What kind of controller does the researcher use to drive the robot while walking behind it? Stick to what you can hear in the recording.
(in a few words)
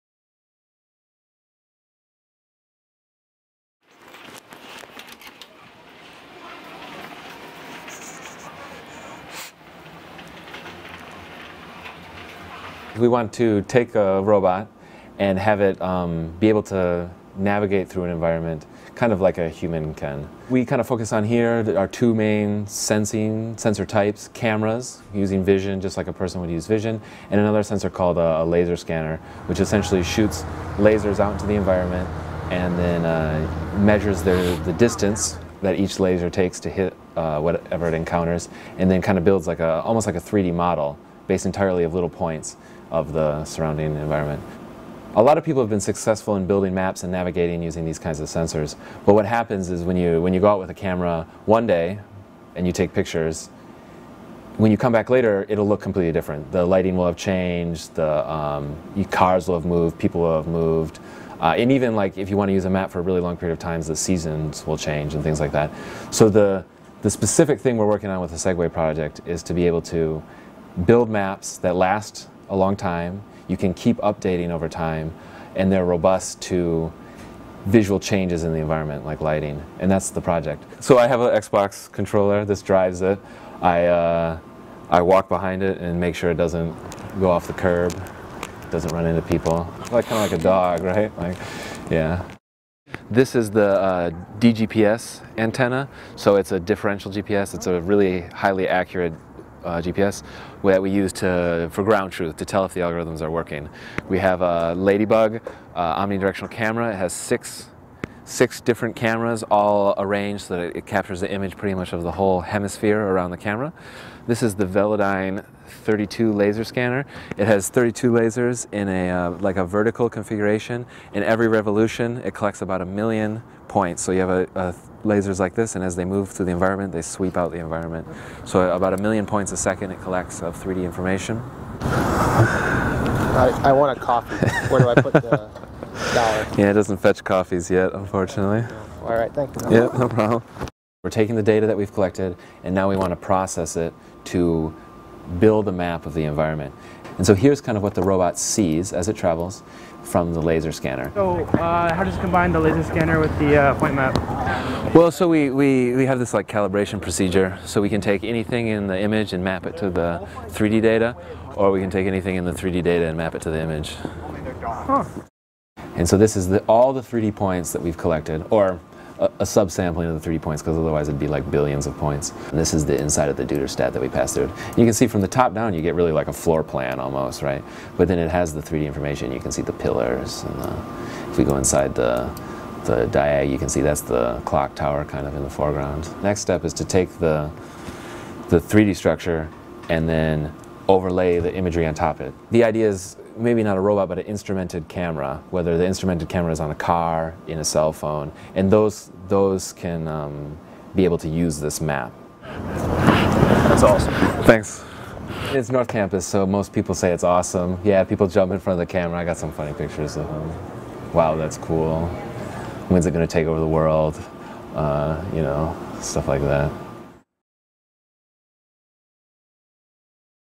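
Xbox controller.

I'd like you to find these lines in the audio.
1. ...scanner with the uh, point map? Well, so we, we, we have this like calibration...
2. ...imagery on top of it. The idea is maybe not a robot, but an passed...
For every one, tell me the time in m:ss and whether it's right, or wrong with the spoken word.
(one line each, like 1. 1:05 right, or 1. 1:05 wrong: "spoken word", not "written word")
1. 2:32 right
2. 3:11 wrong: "instrumented", not "passed".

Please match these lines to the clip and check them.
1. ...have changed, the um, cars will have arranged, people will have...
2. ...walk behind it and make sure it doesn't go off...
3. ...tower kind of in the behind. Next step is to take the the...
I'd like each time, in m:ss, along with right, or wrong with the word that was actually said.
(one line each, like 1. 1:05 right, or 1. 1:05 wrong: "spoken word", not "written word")
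1. 0:57 wrong: "moved", not "arranged"
2. 1:25 right
3. 3:04 wrong: "foreground", not "behind".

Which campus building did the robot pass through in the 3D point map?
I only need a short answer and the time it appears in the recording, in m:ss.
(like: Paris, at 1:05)
Duderstadt, at 2:53.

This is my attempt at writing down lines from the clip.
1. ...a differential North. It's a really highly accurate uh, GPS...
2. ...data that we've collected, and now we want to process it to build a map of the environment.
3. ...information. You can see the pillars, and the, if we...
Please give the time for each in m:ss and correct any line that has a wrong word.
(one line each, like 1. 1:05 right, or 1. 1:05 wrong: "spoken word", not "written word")
1. 1:36 wrong: "GPS", not "North"
2. 2:21 right
3. 2:58 right.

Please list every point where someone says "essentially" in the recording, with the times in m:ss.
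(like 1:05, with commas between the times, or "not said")
0:29.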